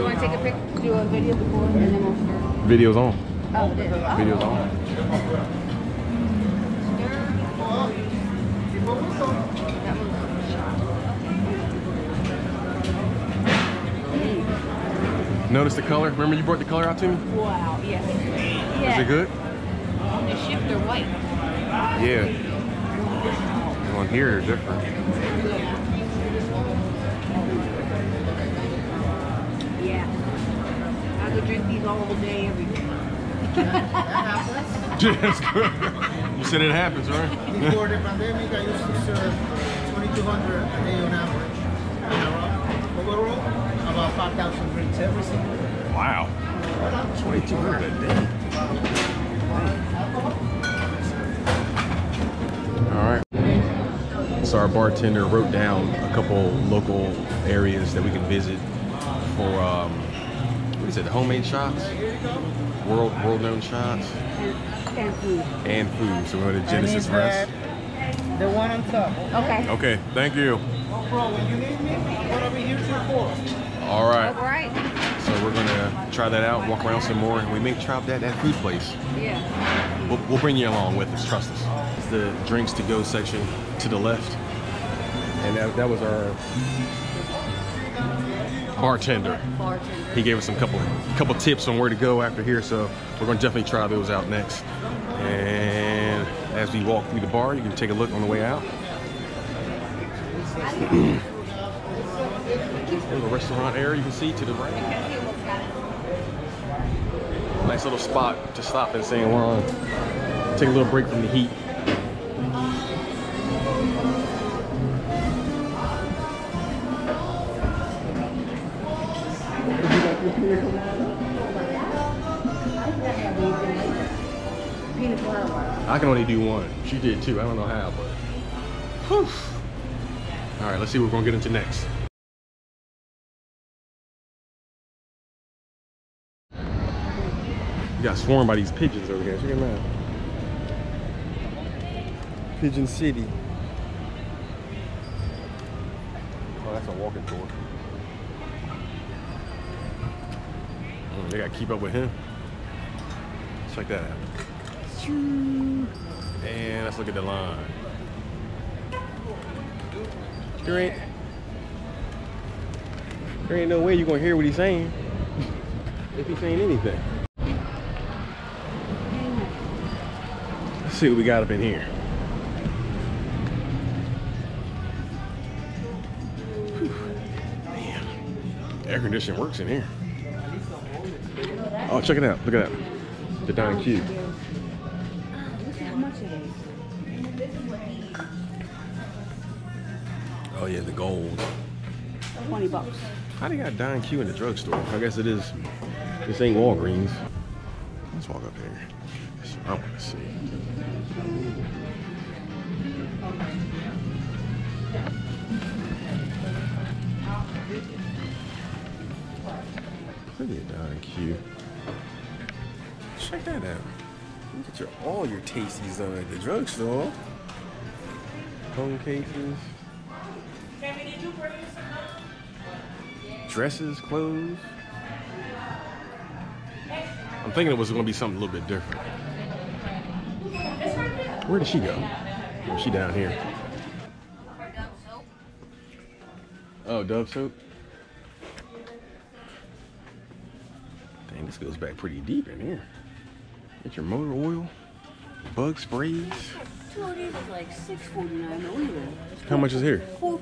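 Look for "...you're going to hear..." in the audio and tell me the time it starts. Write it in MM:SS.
02:43.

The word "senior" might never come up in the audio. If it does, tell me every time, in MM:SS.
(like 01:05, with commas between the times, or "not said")
not said.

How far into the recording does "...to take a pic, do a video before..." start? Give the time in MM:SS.
00:00.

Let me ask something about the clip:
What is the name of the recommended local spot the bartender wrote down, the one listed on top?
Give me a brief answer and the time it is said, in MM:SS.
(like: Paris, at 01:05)
Genesis Rest, at 01:06.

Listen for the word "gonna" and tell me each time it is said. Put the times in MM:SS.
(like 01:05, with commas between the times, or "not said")
01:33, 02:11.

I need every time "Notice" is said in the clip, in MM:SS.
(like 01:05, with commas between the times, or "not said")
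00:15.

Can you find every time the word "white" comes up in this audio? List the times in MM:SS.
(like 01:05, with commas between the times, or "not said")
00:20.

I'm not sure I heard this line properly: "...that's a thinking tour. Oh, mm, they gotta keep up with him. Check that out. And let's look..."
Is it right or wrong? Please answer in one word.
wrong.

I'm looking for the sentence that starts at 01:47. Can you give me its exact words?
Nice little spot to stop in San Juan.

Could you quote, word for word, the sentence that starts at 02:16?
You got swarmed by these pigeons over here.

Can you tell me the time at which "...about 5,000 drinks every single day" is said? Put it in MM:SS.
00:43.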